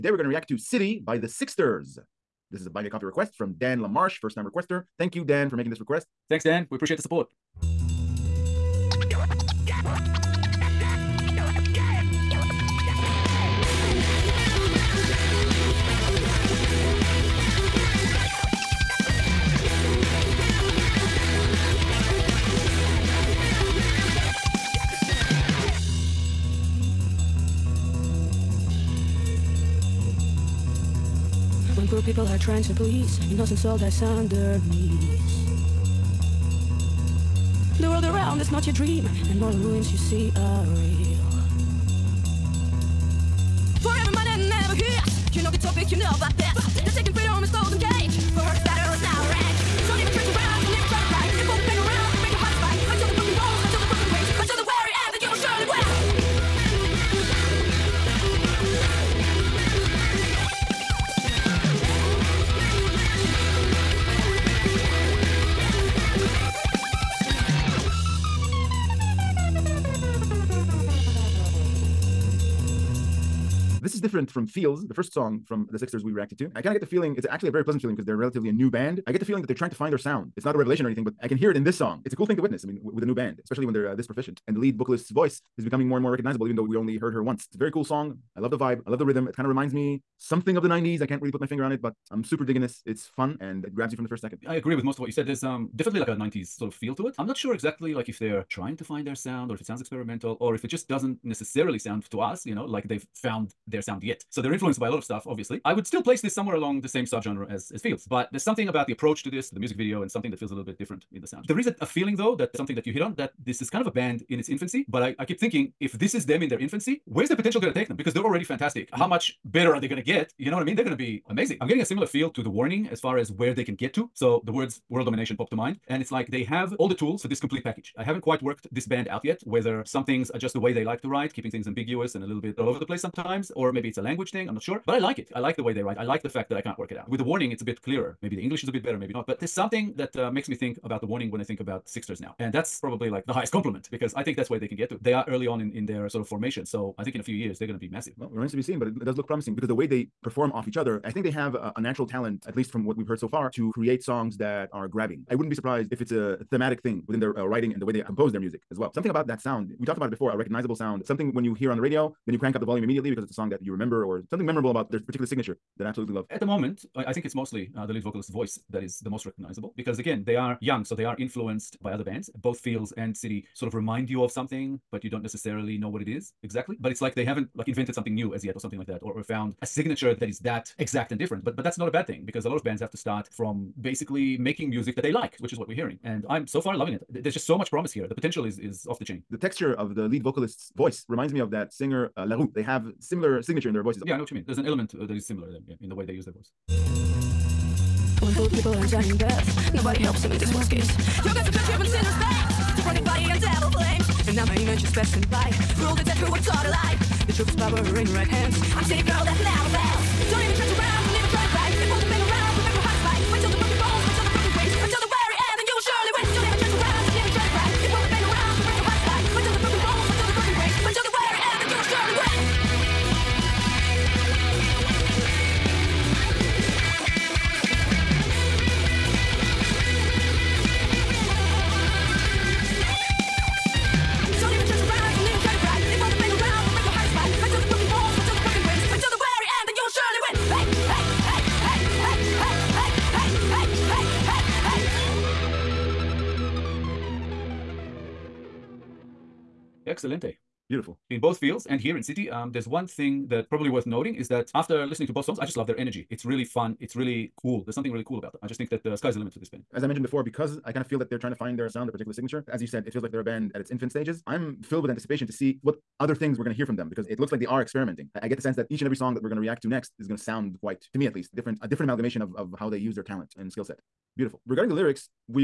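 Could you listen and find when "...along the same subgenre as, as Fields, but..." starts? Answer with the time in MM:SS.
01:46.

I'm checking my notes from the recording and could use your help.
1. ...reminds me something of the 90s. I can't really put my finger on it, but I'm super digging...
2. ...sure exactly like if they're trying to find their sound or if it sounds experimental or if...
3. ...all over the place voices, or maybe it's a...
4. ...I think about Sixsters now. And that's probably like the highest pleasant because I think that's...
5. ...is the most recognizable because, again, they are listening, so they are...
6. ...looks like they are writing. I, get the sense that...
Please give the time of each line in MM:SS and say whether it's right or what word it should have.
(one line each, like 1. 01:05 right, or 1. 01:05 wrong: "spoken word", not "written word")
1. 01:29 right
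2. 01:37 right
3. 02:12 wrong: "sometimes", not "voices"
4. 02:21 wrong: "compliment", not "pleasant"
5. 02:48 wrong: "young", not "listening"
6. 04:27 wrong: "experimenting", not "writing".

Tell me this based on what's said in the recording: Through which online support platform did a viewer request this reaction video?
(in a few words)
Buy Me a Coffee.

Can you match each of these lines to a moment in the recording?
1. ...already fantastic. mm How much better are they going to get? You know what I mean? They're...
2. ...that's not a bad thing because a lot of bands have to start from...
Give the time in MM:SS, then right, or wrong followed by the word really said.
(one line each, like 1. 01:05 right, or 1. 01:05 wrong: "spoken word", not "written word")
1. 01:58 right
2. 03:01 right.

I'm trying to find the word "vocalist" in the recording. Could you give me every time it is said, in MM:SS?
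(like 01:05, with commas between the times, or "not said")
01:24, 02:48, 03:10.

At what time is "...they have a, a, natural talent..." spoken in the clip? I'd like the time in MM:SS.
02:31.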